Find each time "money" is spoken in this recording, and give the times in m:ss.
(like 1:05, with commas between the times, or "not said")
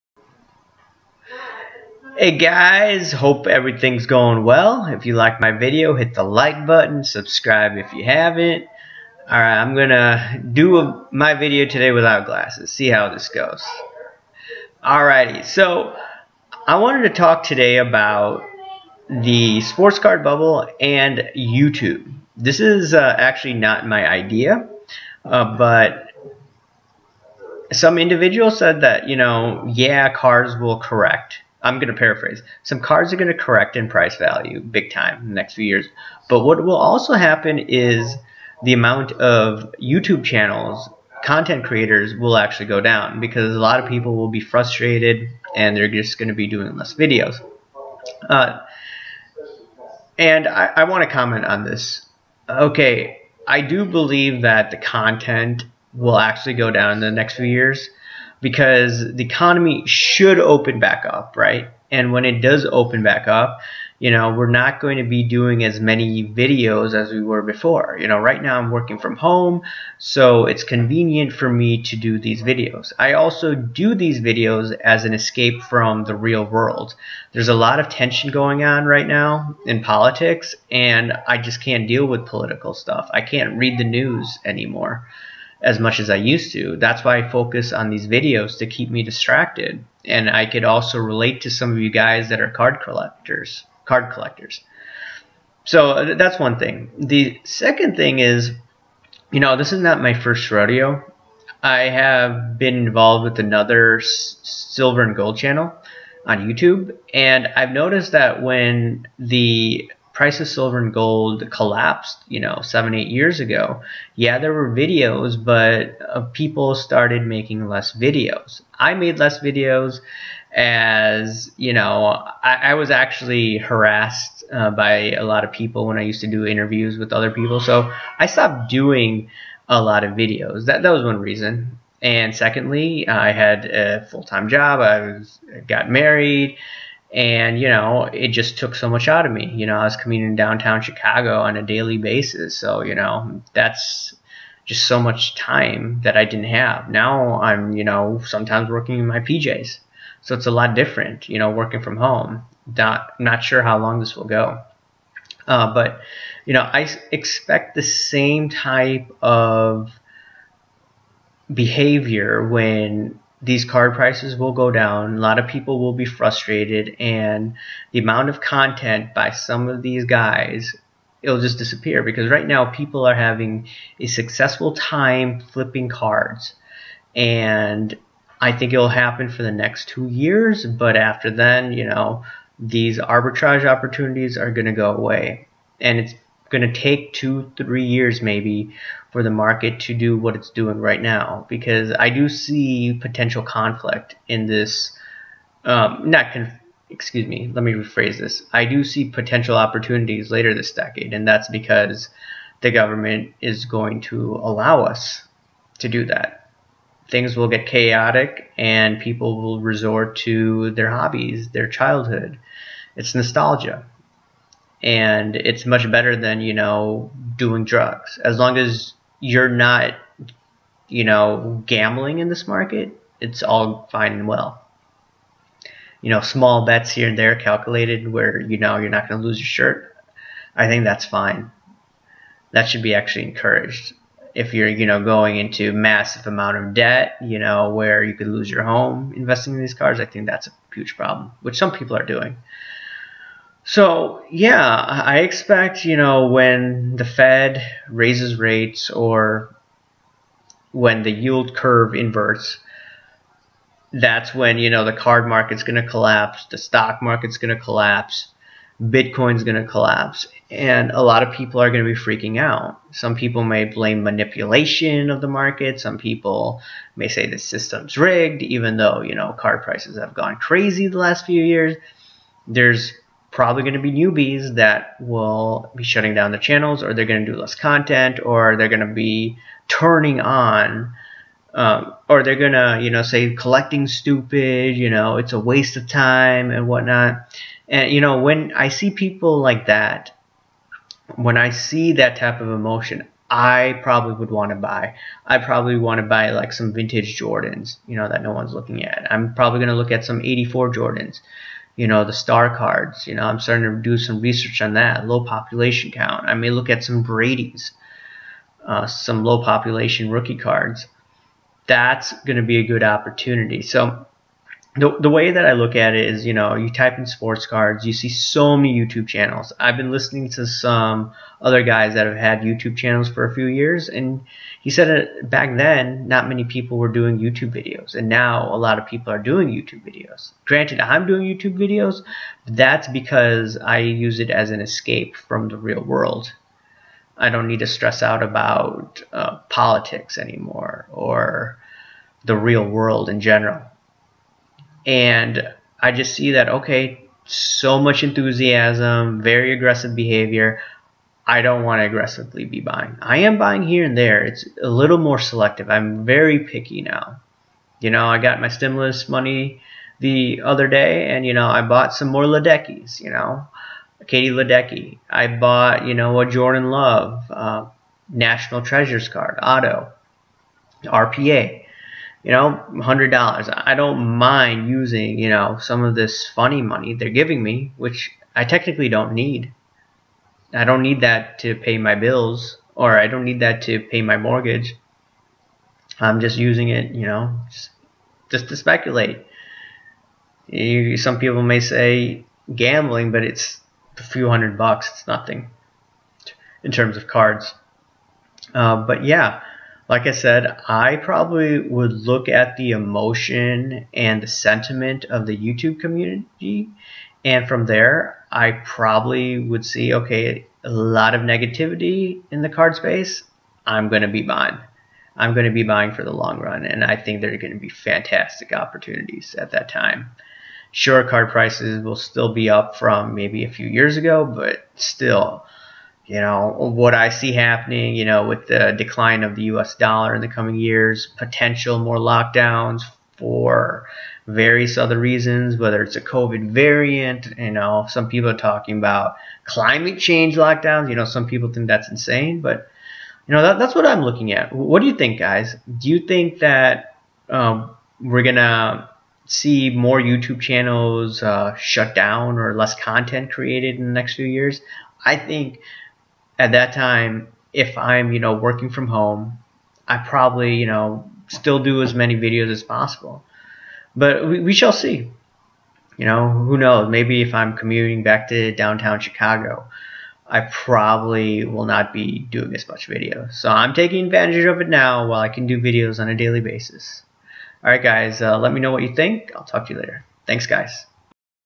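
5:59, 6:16.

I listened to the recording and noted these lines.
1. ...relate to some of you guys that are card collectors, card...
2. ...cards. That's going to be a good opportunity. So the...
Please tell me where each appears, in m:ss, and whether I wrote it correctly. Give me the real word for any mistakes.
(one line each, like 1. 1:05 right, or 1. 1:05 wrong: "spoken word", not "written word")
1. 1:30 right
2. 5:10 right.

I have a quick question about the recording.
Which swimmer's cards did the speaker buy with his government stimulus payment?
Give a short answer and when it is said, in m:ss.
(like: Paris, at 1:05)
Katie Ledecky, at 6:04.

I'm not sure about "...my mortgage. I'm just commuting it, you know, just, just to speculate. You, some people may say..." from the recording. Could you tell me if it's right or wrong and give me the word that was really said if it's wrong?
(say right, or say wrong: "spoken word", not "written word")
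wrong: "using", not "commuting".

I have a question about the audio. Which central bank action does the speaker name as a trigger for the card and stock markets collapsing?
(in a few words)
Fed raises rates.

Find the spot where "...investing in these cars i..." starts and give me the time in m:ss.
3:59.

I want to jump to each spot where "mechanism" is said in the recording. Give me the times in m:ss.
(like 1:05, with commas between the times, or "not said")
not said.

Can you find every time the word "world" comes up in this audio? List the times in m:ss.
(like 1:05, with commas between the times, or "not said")
1:16, 5:35, 5:42.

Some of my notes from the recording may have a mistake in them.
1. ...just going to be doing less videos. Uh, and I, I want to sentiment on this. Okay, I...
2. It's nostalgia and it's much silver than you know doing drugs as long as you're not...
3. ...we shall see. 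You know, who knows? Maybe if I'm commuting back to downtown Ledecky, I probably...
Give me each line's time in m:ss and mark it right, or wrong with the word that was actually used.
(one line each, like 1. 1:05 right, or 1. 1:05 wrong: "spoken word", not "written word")
1. 0:45 wrong: "comment", not "sentiment"
2. 3:32 wrong: "better", not "silver"
3. 7:44 wrong: "Chicago", not "Ledecky".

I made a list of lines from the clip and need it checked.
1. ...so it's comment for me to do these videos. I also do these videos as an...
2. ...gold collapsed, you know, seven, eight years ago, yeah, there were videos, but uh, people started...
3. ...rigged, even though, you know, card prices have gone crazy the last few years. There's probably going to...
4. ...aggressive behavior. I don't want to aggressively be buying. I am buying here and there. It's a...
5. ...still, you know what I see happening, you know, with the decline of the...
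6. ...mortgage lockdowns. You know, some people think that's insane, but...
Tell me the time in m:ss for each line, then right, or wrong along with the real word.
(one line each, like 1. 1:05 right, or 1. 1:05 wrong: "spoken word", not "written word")
1. 1:09 wrong: "convenient", not "comment"
2. 1:50 right
3. 4:27 right
4. 5:49 right
5. 7:04 right
6. 7:19 wrong: "change", not "mortgage".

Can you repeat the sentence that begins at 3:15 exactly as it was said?
Um, not conf- excuse me, let me rephrase this.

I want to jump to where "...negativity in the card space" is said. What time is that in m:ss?
6:51.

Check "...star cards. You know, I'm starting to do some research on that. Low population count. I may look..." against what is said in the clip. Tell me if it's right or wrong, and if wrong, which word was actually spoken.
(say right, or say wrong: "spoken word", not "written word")
right.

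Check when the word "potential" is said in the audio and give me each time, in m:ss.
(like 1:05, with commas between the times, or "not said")
3:13, 3:19, 7:11.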